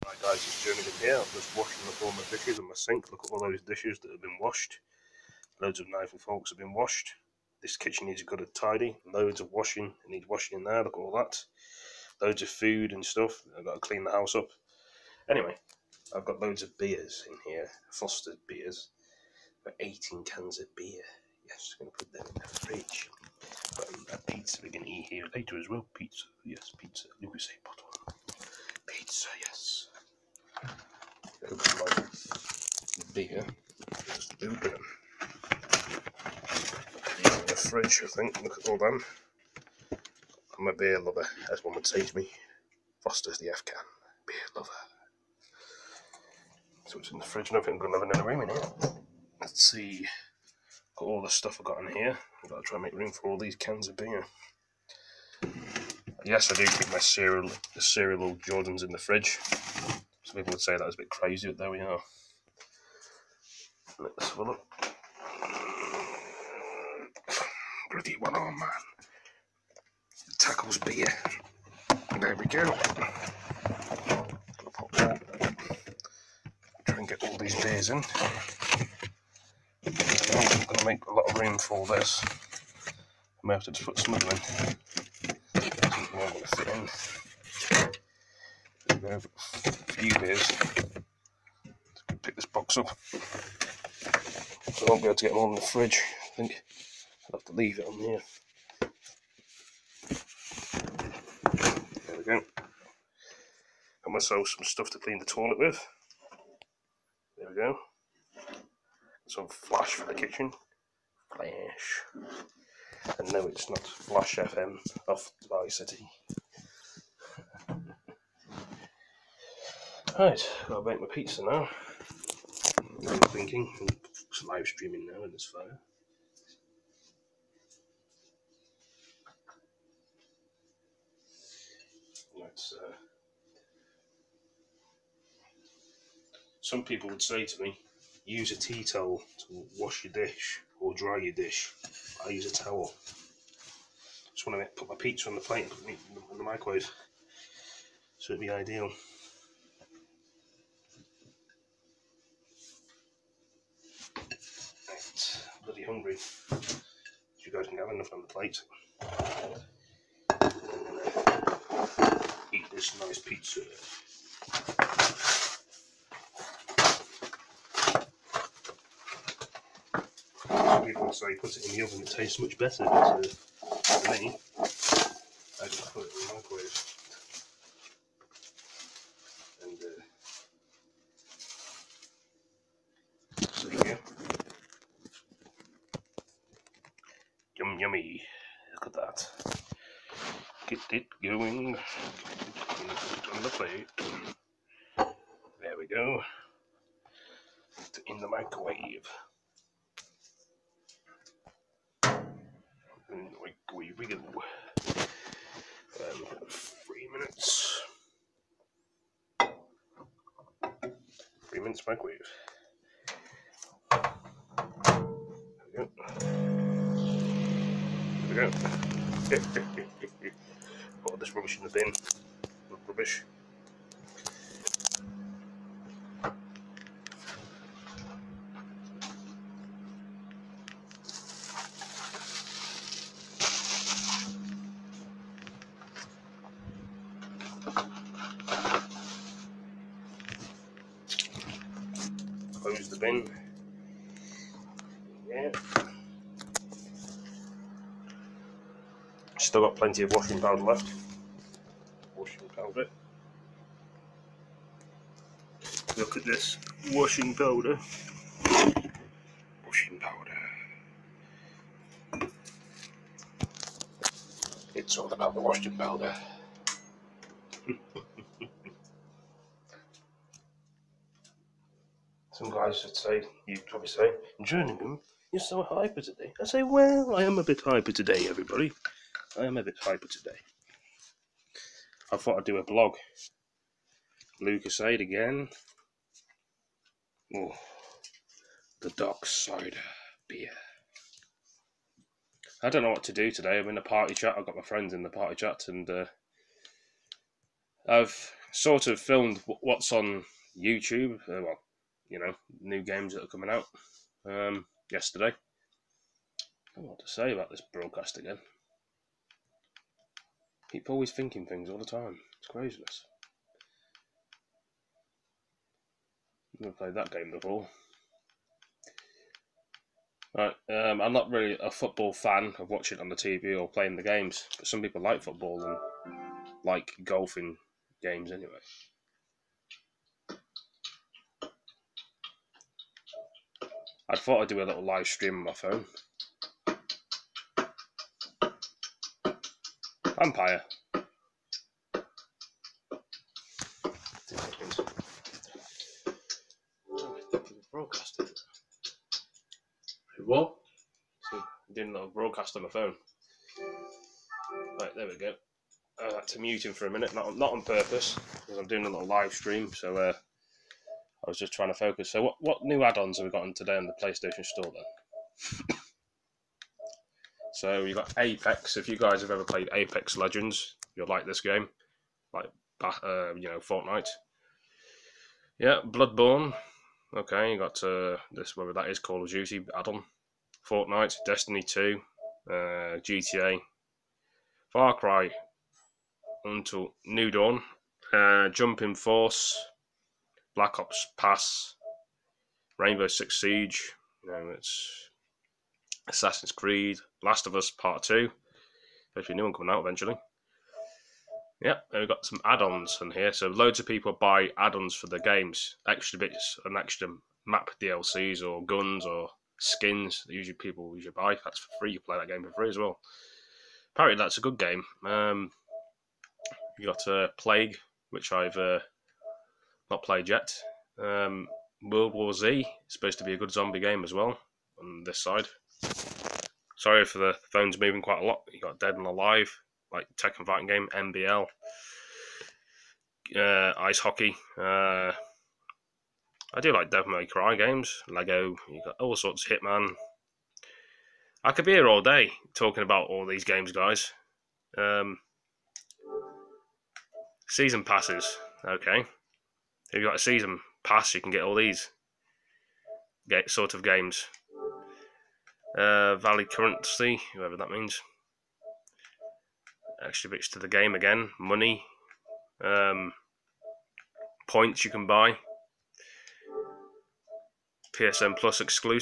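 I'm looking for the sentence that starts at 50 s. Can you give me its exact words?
Got all the stuff I've got in here.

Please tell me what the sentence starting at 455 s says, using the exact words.
Uh, Valley currency, whoever that means.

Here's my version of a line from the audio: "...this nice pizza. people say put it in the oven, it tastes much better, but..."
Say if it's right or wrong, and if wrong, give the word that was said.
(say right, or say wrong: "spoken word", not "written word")
right.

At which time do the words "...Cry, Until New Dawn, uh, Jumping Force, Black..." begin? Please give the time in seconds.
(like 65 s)
384 s.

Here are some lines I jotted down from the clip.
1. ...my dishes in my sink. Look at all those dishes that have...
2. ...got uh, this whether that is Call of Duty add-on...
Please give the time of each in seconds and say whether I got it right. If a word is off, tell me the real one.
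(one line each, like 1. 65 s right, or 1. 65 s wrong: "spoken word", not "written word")
1. 2 s right
2. 377 s right.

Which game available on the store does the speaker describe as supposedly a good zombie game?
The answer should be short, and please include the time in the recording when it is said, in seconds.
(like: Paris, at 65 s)
World War Z, at 421 s.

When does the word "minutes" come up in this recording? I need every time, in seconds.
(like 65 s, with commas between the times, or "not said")
207 s, 211 s, 356 s.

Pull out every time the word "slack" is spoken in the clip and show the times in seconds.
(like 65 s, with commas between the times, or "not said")
not said.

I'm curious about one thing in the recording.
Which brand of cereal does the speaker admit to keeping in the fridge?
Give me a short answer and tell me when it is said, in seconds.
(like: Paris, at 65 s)
Jordans, at 57 s.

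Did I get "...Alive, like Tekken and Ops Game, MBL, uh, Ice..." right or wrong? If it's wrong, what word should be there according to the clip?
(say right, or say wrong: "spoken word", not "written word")
wrong: "Fighting", not "Ops".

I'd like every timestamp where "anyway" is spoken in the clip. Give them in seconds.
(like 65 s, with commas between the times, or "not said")
15 s, 328 s.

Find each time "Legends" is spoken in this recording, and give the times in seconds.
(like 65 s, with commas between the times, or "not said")
370 s.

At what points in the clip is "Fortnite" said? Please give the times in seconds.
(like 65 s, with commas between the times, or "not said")
373 s, 380 s.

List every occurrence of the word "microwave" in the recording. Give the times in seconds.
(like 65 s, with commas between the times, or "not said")
146 s, 176 s, 198 s, 203 s, 211 s.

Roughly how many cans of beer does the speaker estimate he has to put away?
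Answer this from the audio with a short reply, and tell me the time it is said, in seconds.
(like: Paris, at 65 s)
18, at 19 s.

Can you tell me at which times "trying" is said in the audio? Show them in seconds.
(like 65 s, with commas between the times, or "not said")
361 s.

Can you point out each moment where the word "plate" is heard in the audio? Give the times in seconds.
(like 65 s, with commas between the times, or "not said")
145 s, 158 s, 193 s.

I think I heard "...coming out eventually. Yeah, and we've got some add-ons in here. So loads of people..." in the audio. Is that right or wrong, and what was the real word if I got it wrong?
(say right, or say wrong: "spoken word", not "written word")
right.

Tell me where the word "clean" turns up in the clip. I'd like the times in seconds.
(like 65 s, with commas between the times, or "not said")
13 s, 104 s.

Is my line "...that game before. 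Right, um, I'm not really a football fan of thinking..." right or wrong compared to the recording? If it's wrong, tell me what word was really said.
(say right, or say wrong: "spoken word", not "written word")
wrong: "watching", not "thinking".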